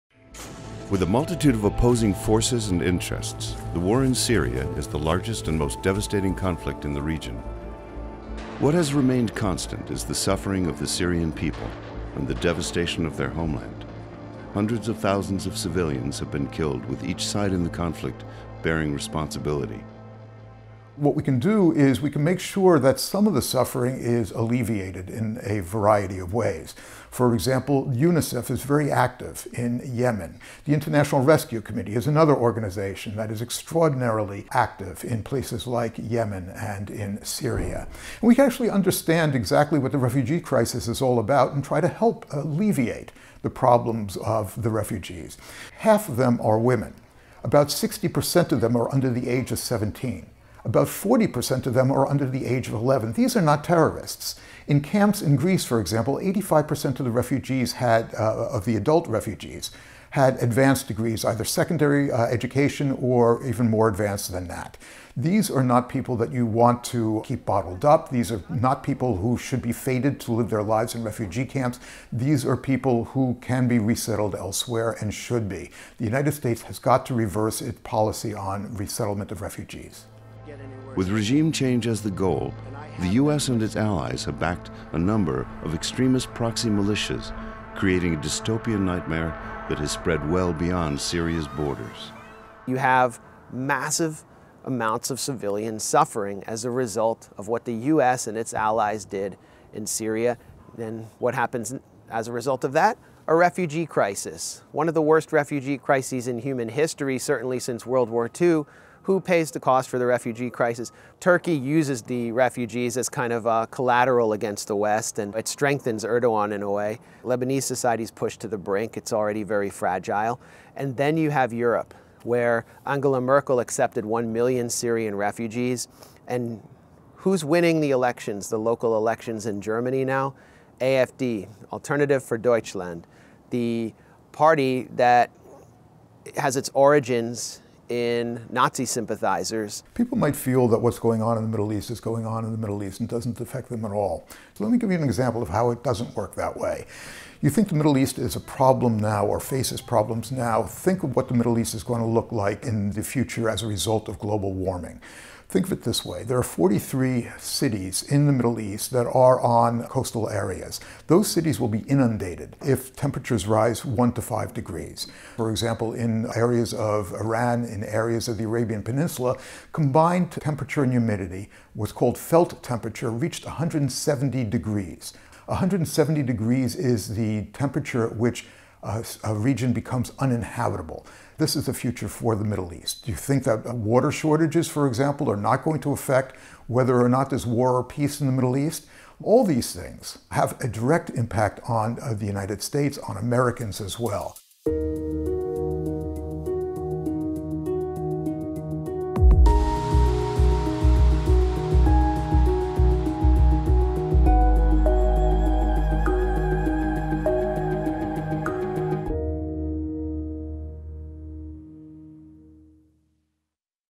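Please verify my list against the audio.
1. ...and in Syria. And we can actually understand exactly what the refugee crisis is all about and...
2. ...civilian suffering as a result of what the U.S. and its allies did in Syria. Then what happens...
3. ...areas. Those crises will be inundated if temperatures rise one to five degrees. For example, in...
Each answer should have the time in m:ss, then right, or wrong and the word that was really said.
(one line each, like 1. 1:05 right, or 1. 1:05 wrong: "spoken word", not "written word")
1. 0:36 right
2. 1:35 right
3. 2:40 wrong: "cities", not "crises".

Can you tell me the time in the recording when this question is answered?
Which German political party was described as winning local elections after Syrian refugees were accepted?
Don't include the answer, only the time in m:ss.
2:10.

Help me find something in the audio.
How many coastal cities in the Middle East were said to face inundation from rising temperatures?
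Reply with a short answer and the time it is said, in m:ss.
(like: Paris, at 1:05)
43, at 2:36.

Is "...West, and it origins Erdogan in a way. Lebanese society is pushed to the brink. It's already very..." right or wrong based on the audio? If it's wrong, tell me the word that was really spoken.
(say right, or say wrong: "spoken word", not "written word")
wrong: "strengthens", not "origins".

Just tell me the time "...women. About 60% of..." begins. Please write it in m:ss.
0:46.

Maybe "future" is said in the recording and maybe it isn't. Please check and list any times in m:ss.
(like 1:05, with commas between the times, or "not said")
2:33, 3:01.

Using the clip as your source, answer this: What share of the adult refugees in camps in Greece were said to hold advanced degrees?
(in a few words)
85%.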